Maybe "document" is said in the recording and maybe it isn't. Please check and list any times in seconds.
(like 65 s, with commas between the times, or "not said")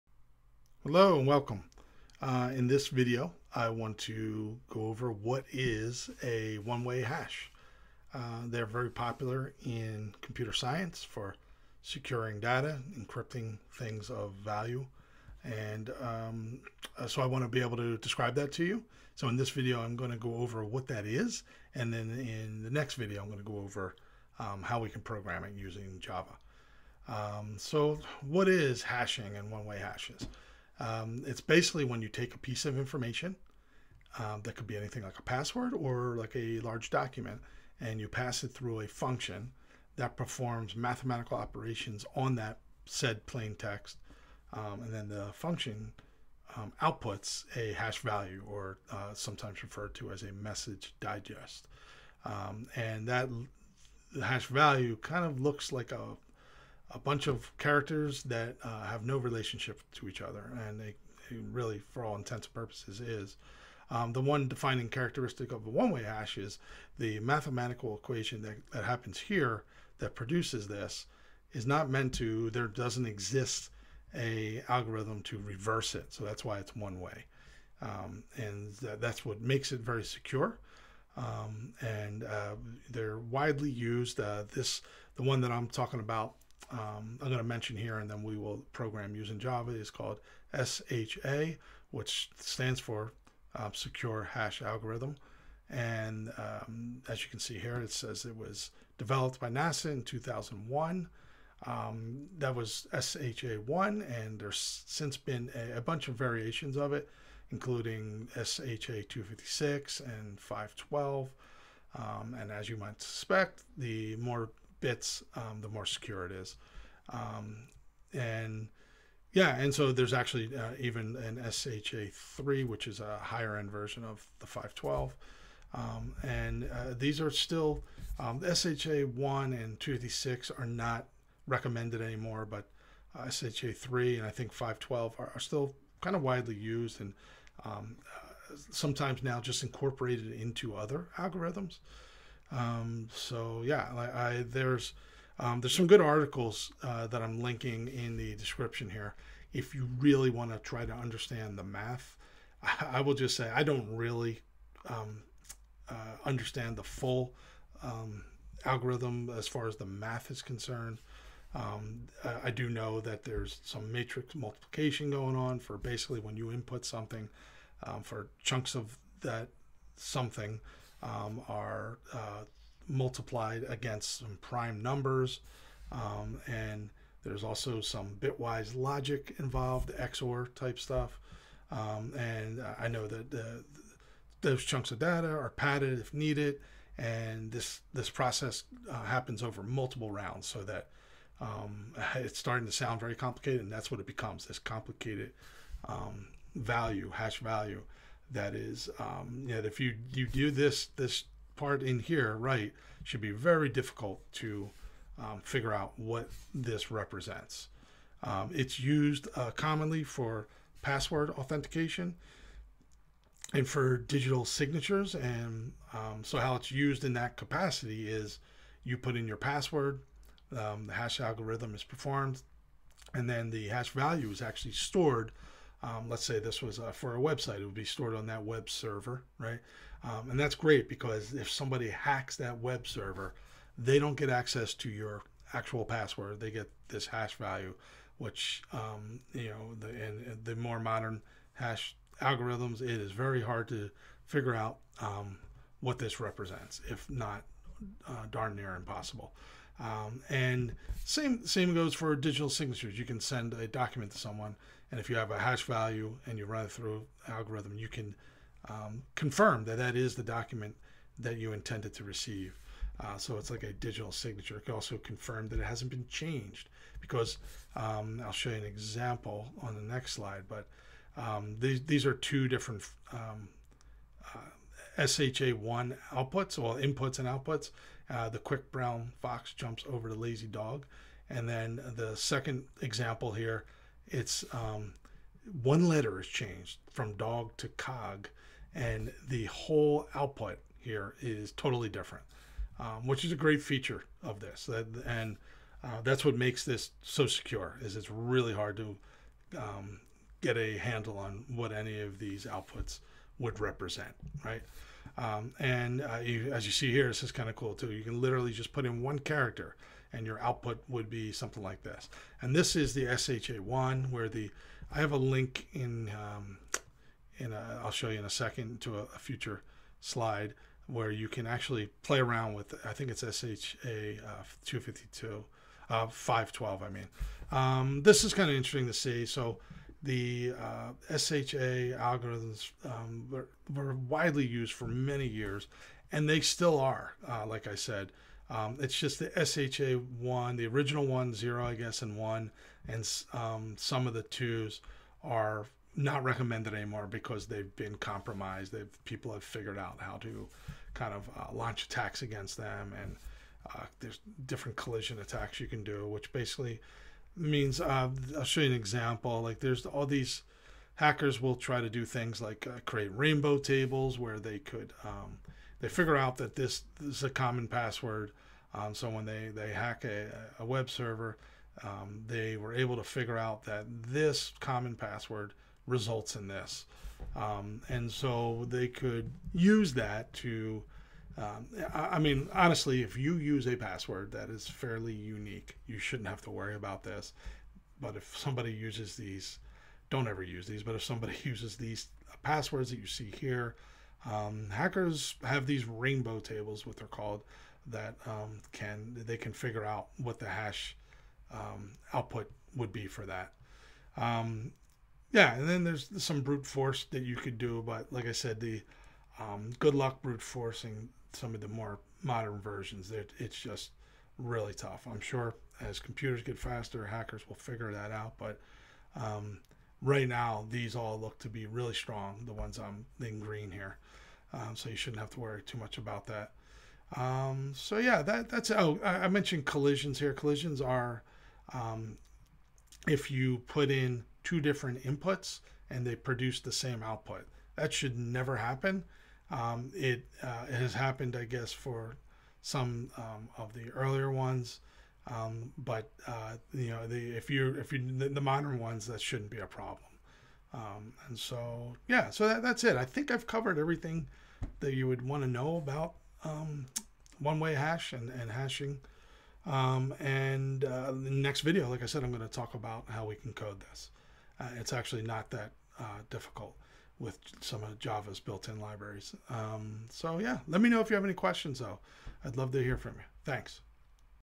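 36 s, 253 s, 260 s.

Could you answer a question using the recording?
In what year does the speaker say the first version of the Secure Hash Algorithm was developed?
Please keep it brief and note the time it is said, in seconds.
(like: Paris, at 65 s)
2001, at 100 s.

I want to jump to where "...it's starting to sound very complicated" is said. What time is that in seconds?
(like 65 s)
192 s.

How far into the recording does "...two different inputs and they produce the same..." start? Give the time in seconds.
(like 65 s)
434 s.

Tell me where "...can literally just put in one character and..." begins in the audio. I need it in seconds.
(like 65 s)
308 s.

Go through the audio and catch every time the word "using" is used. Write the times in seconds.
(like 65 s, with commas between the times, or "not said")
25 s, 89 s.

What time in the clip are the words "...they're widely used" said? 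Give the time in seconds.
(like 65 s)
82 s.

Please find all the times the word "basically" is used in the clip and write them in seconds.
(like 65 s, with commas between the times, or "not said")
31 s, 165 s, 356 s.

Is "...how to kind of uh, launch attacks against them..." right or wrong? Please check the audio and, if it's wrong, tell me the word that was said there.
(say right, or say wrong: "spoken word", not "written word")
right.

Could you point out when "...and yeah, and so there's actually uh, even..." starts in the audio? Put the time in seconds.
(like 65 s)
118 s.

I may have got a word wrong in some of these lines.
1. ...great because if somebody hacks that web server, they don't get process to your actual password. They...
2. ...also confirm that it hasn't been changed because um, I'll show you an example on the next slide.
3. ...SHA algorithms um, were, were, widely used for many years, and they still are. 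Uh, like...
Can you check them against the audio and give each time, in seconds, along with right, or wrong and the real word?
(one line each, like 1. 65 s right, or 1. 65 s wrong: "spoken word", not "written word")
1. 230 s wrong: "access", not "process"
2. 264 s right
3. 331 s right.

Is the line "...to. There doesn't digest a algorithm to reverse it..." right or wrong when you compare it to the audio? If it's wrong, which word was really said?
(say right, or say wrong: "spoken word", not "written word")
wrong: "exist", not "digest".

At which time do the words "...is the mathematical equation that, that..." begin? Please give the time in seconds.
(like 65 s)
66 s.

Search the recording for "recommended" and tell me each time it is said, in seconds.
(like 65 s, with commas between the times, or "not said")
131 s, 346 s.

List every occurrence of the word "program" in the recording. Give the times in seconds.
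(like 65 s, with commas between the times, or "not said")
25 s, 88 s.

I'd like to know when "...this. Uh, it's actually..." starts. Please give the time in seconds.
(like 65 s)
463 s.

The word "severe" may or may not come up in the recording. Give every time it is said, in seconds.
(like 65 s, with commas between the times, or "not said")
not said.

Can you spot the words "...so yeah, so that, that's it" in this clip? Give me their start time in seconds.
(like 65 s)
451 s.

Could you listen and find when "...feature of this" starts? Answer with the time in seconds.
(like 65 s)
293 s.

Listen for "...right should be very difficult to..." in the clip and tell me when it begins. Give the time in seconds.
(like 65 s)
202 s.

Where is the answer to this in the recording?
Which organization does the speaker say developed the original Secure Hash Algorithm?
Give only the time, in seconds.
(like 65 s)
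99 s.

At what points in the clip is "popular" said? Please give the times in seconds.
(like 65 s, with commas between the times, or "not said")
8 s.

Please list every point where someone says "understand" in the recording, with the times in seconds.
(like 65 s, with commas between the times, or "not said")
150 s, 156 s.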